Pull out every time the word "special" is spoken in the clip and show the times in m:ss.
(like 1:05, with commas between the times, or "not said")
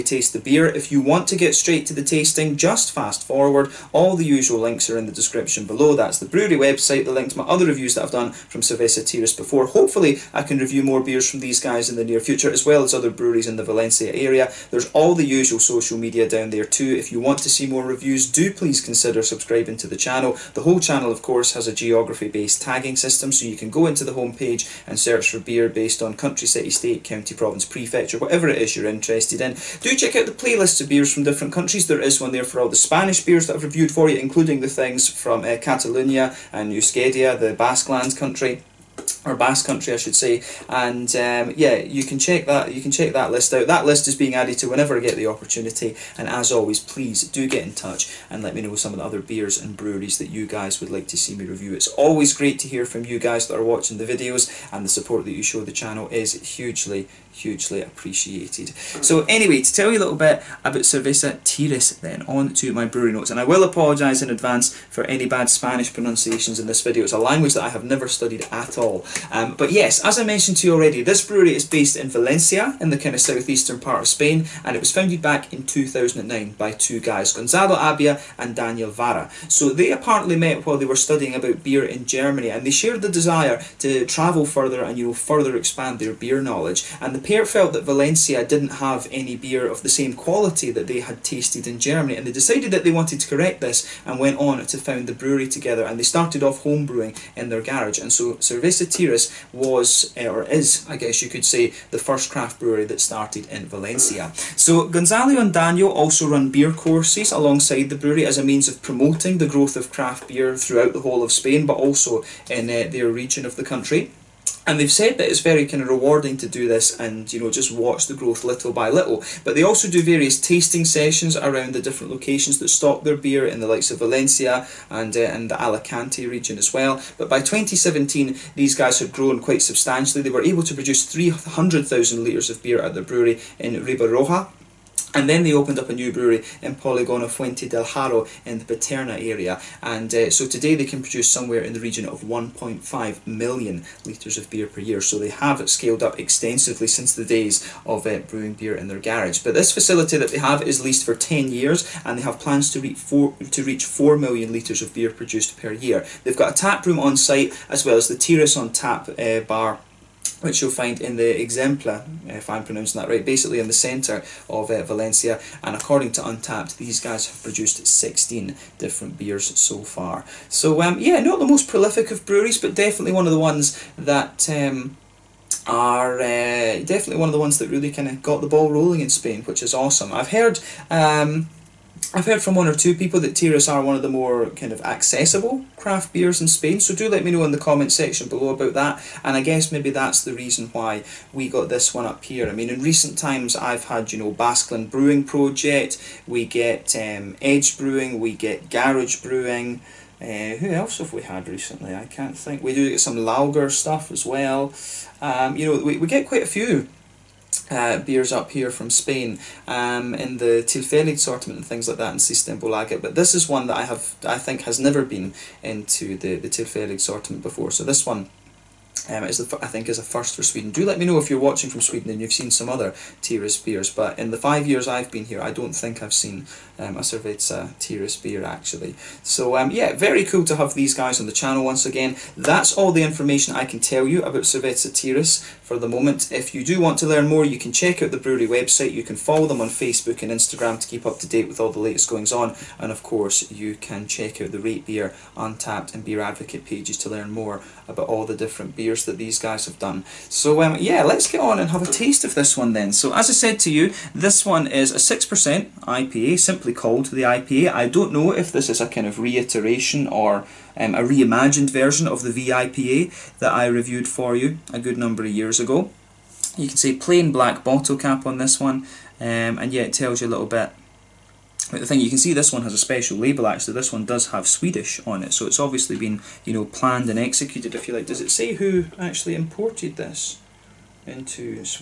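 4:32.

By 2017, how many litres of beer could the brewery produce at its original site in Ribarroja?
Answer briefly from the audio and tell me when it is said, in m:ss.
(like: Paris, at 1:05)
300,000 litres, at 2:11.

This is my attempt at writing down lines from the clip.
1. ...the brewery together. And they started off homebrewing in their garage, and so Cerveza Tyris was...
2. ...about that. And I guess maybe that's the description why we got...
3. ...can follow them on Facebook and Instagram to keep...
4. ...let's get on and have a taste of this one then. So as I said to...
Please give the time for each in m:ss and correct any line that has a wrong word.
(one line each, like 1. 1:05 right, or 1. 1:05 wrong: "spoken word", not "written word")
1. 1:35 right
2. 3:08 wrong: "reason", not "description"
3. 3:59 right
4. 4:11 right.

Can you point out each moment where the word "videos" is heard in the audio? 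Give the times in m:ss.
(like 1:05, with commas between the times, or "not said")
0:54, 1:06.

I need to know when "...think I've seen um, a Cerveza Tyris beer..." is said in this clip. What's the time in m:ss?
3:45.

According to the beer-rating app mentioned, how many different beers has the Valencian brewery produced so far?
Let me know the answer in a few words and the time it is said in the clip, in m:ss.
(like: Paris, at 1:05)
16, at 2:47.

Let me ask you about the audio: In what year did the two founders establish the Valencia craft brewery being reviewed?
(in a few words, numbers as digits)
2009.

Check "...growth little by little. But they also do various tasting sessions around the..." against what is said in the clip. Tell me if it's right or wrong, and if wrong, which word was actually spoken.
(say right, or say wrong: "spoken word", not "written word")
right.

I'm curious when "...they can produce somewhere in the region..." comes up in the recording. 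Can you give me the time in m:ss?
2:20.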